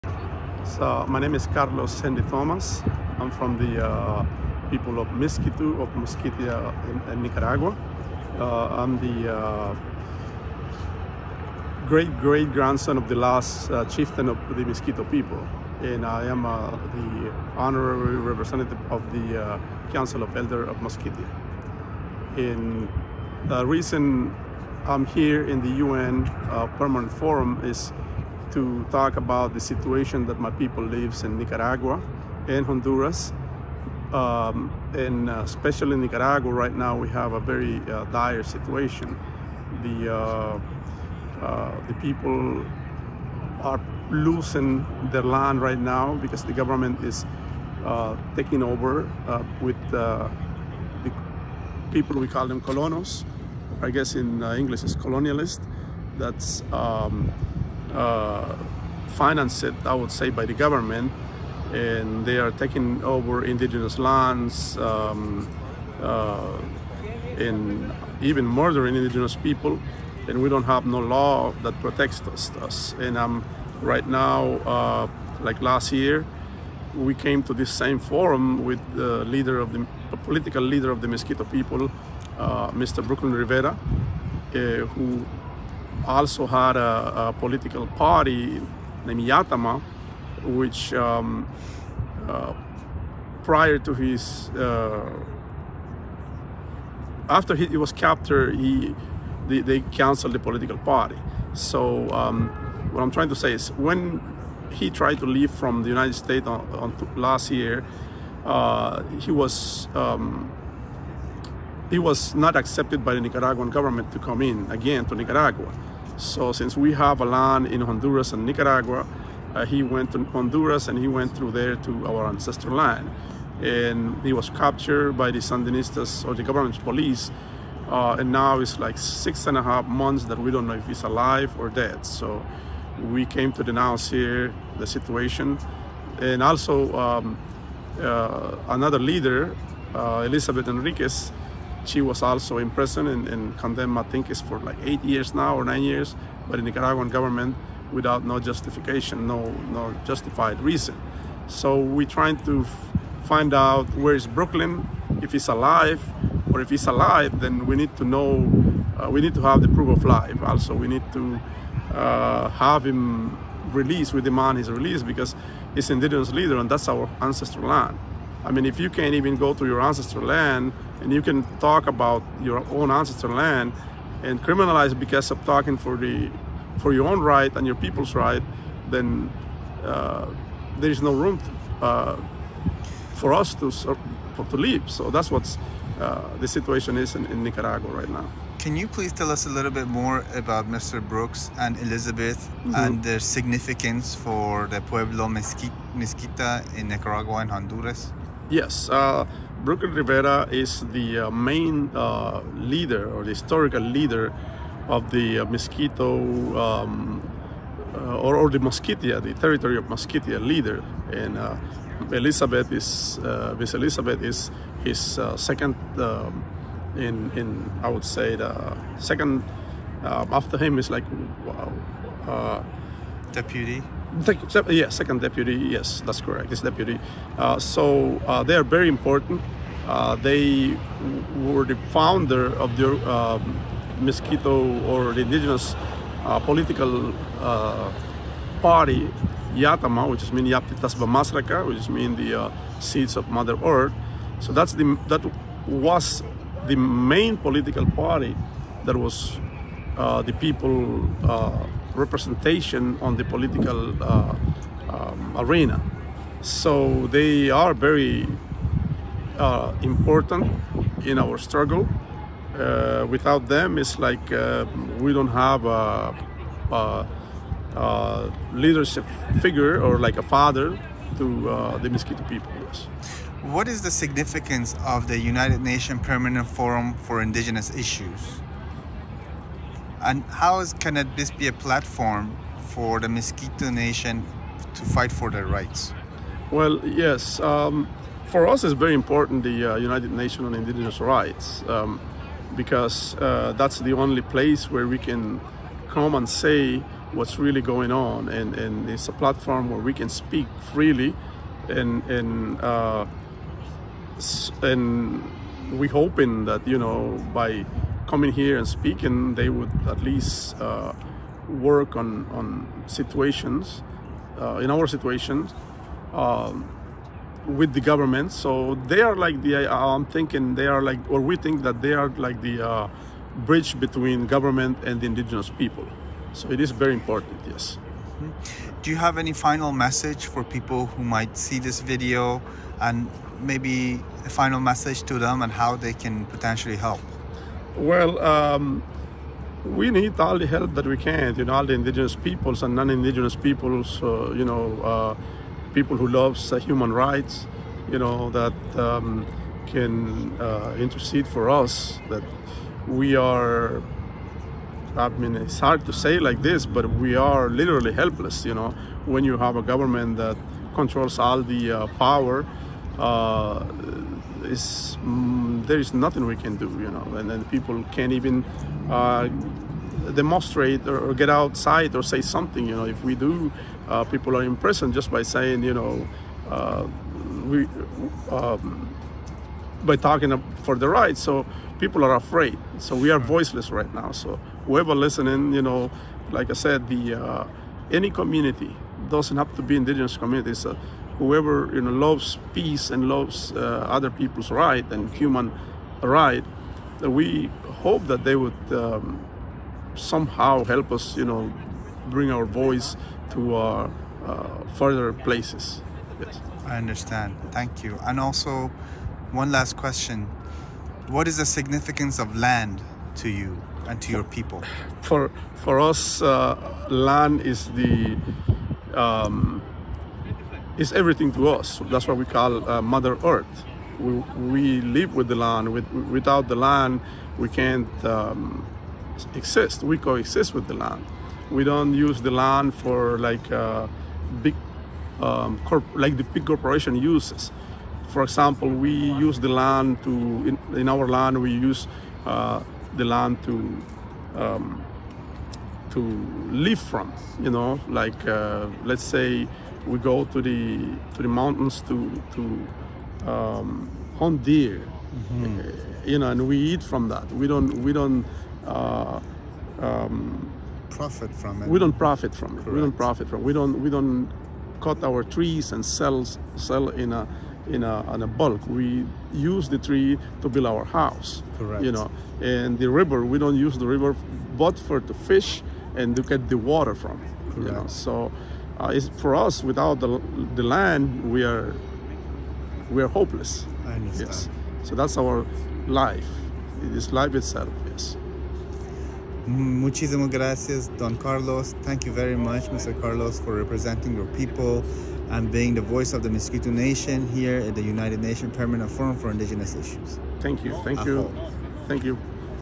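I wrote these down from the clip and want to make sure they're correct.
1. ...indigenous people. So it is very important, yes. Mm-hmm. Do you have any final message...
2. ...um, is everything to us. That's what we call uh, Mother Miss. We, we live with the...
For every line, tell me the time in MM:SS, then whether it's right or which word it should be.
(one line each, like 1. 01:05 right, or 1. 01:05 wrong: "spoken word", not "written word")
1. 05:25 right
2. 06:58 wrong: "Earth", not "Miss".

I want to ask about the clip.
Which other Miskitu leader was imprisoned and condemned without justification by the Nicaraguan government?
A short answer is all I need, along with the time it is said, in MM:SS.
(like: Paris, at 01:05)
Elizabeth Henríquez, at 02:20.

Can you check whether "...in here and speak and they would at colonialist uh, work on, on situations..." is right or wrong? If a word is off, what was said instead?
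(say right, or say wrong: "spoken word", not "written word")
wrong: "least", not "colonialist".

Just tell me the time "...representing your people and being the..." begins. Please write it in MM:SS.
08:13.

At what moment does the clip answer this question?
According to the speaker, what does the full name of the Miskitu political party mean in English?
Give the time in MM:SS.
04:02.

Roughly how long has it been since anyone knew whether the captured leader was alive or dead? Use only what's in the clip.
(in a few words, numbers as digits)
six and a half months.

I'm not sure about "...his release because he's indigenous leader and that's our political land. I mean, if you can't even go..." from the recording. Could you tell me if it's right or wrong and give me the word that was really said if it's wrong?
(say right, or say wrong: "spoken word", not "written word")
wrong: "ancestral", not "political".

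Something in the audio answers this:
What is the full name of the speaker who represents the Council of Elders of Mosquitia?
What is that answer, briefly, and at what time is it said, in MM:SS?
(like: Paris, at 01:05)
Carlos Hendy Thomas, at 00:01.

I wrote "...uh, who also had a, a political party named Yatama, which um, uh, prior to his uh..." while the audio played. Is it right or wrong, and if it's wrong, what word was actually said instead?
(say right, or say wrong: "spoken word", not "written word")
right.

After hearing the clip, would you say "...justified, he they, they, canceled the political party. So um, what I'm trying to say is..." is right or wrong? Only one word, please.
wrong.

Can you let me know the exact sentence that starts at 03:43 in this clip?
Deputy yeah, second deputy, yes, that's correct, it's deputy.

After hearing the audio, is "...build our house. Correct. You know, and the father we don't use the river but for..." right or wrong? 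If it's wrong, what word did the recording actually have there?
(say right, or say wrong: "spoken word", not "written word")
wrong: "river", not "father".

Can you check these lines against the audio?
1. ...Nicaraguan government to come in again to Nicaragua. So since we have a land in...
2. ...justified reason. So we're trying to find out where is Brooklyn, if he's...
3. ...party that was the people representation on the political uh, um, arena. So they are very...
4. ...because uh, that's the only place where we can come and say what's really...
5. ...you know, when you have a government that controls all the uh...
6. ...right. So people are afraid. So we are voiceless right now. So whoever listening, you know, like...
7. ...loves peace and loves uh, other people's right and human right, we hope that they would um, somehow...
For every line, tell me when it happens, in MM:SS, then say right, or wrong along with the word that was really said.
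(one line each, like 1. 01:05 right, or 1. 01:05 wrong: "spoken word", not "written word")
1. 01:53 right
2. 02:30 right
3. 04:07 right
4. 04:52 right
5. 05:58 right
6. 06:20 right
7. 06:31 right.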